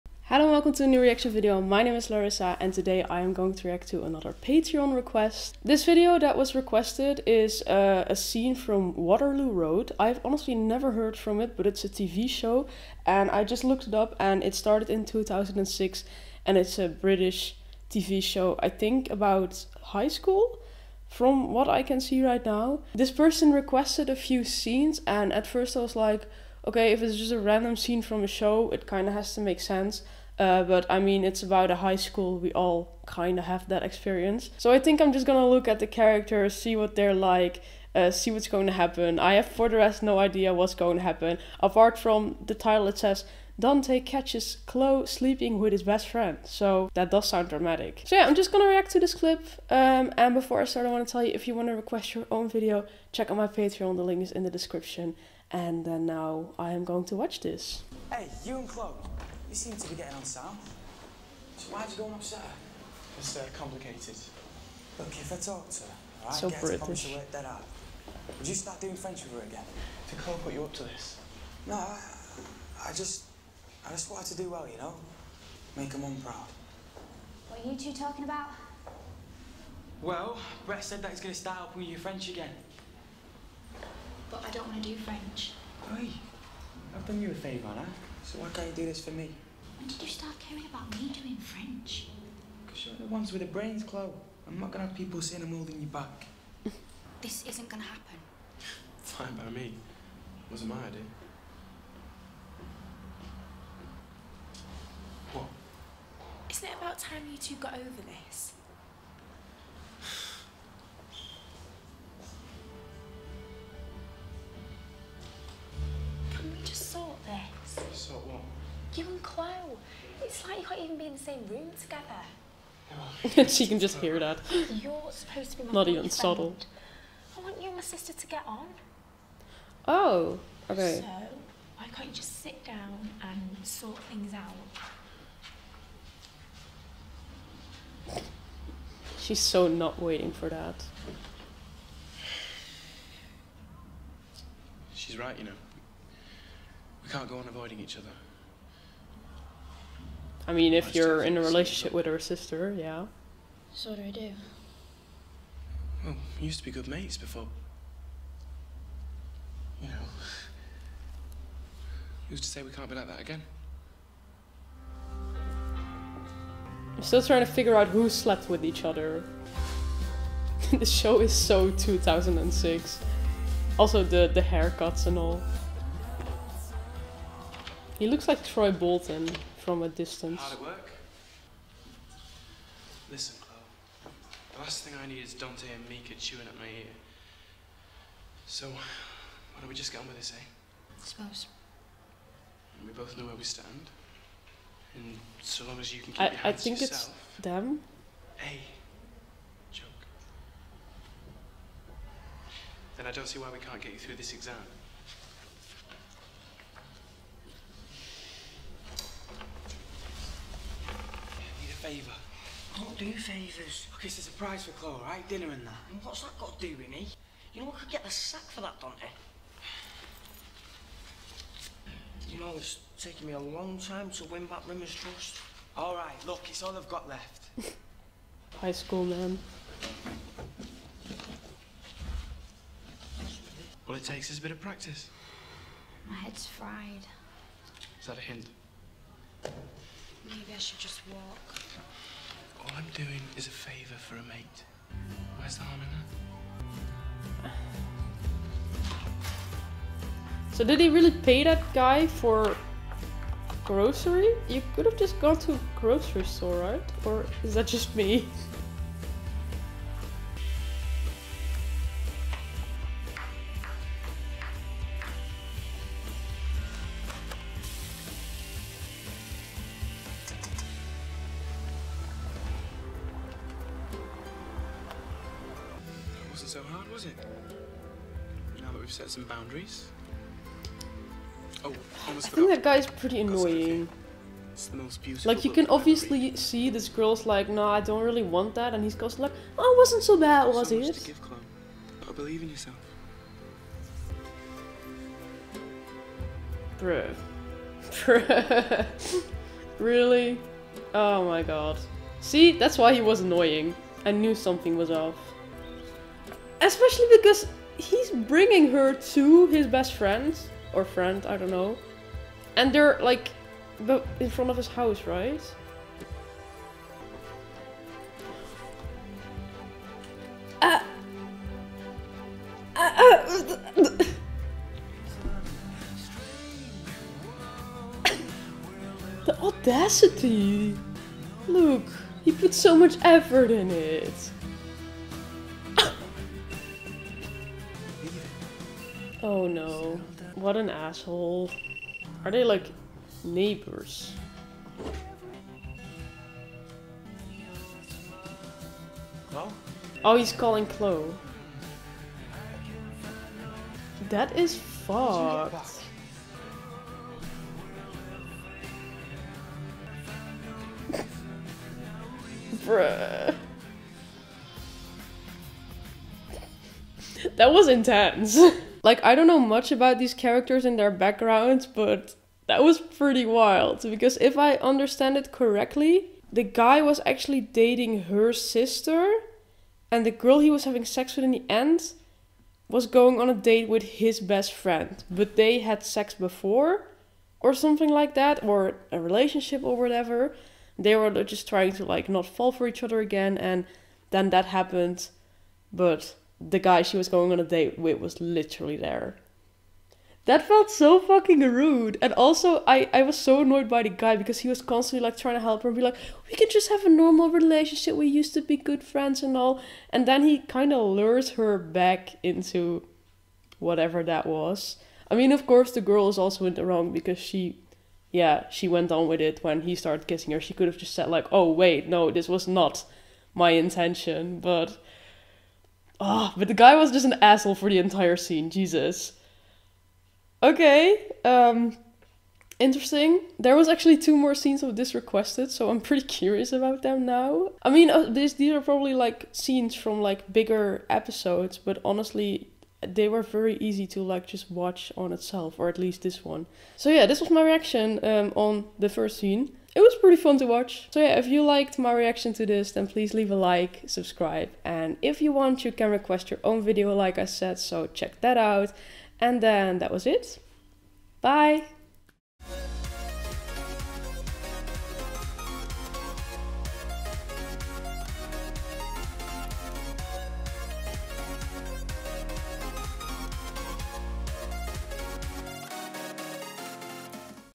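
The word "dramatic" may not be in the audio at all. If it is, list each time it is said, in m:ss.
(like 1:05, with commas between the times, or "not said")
0:47.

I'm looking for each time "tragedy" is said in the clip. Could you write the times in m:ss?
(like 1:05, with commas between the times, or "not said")
not said.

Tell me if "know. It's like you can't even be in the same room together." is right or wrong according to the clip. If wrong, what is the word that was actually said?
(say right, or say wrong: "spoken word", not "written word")
right.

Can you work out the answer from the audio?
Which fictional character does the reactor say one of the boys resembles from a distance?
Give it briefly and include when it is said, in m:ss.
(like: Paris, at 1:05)
Troy Bolton, at 2:58.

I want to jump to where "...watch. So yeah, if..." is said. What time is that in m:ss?
7:30.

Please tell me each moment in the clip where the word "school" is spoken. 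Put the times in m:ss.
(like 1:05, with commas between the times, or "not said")
0:20, 0:31, 3:48.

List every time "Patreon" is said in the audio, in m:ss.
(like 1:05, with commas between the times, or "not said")
0:04, 0:53.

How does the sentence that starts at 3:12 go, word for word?
And we both know where we stand.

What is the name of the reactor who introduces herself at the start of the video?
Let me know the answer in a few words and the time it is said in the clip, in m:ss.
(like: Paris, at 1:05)
Larissa, at 0:02.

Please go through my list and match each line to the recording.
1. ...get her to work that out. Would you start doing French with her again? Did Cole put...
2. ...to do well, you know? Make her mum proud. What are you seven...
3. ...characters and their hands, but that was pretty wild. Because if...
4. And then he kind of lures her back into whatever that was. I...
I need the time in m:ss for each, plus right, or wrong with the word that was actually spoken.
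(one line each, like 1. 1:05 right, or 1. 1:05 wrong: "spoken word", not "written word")
1. 1:06 right
2. 1:14 wrong: "two", not "seven"
3. 6:10 wrong: "backgrounds", not "hands"
4. 6:49 right.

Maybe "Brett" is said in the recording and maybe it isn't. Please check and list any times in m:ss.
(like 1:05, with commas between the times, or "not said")
1:20.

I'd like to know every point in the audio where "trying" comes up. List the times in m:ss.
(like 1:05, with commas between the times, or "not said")
2:47, 6:31, 6:45.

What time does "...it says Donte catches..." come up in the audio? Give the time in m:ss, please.
0:42.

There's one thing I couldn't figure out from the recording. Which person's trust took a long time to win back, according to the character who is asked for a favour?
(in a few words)
Rimmer.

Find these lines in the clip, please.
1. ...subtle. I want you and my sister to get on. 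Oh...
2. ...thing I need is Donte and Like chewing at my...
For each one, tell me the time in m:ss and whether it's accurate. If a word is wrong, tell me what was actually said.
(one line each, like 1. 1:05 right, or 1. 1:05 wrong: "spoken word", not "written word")
1. 2:06 right
2. 3:04 wrong: "Mika", not "Like".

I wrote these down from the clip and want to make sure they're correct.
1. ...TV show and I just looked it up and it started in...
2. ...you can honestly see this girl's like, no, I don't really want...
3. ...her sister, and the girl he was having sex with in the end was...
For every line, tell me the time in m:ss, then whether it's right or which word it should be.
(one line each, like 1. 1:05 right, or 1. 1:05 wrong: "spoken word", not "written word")
1. 0:11 right
2. 4:45 wrong: "obviously", not "honestly"
3. 6:18 right.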